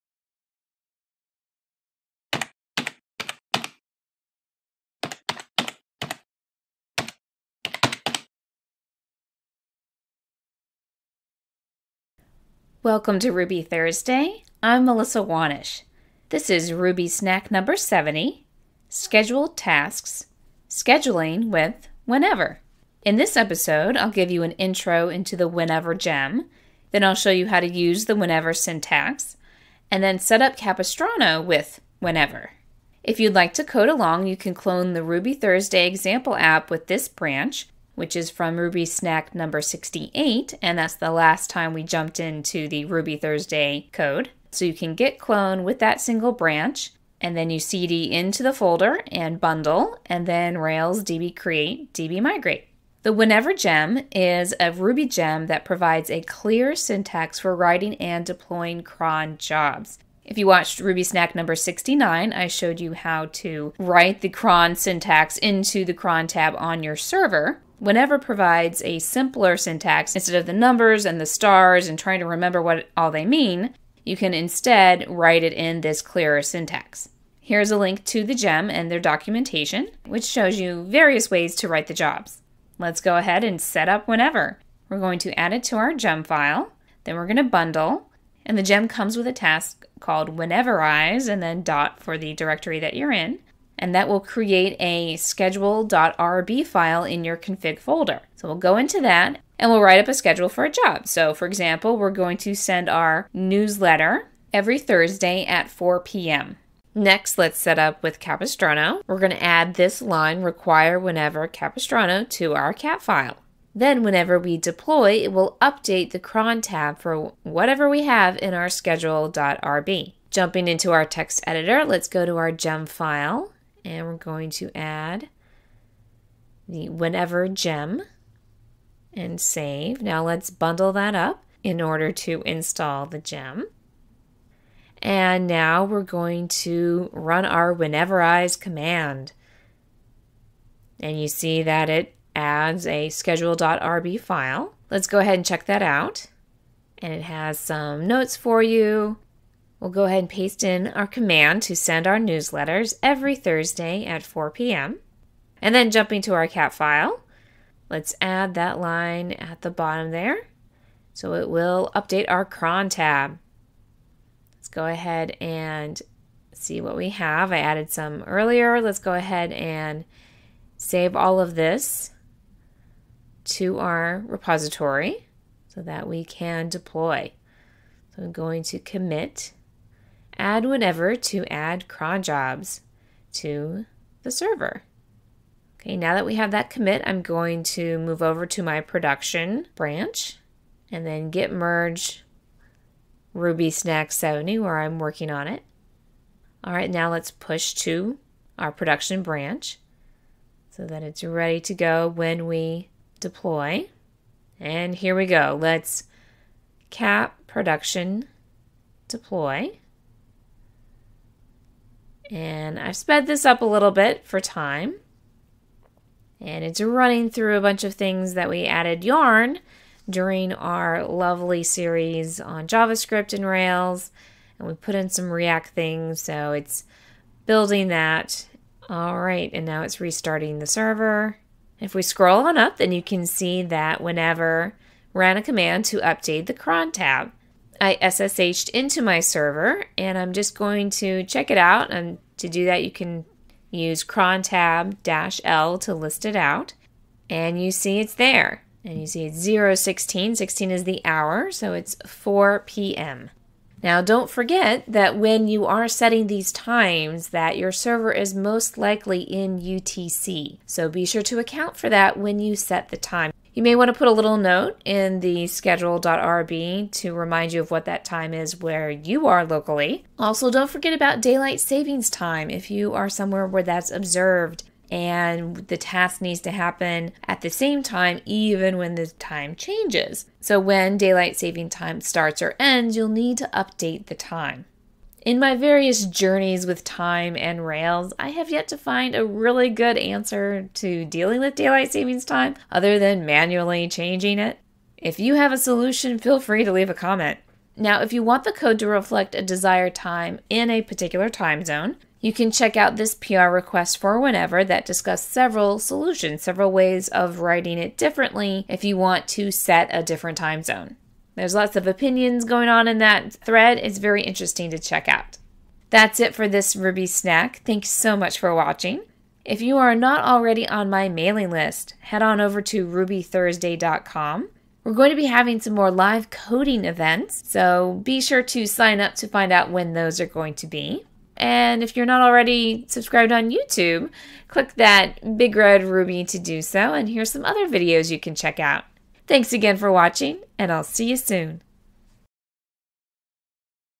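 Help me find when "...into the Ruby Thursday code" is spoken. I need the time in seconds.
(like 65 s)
42 s.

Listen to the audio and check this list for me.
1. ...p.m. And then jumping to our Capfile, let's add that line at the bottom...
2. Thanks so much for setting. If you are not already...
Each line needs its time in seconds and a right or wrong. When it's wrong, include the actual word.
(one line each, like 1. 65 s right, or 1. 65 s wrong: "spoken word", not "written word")
1. 154 s right
2. 317 s wrong: "watching", not "setting".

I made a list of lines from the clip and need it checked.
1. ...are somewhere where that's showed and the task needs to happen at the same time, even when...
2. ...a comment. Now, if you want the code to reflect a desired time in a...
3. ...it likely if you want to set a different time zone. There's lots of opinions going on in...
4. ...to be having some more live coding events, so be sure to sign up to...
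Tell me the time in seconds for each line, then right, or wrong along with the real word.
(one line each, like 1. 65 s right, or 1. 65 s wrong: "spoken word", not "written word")
1. 272 s wrong: "observed", not "showed"
2. 296 s right
3. 307 s wrong: "differently", not "likely"
4. 325 s right.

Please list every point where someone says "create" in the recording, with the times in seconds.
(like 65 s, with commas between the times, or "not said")
51 s, 94 s.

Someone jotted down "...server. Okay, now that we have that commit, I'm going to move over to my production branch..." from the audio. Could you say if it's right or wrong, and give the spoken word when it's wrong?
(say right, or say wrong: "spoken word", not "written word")
right.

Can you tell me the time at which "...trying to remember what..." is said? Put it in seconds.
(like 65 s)
71 s.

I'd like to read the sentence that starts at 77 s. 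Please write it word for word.
Here's a link to the GEM and their documentation, which shows you various ways to write the jobs.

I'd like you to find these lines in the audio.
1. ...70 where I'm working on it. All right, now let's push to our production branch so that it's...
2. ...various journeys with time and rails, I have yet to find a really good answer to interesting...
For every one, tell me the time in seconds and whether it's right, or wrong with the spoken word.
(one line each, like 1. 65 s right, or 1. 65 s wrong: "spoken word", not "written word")
1. 194 s right
2. 285 s wrong: "dealing", not "interesting".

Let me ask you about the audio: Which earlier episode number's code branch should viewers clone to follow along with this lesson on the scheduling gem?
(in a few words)
68.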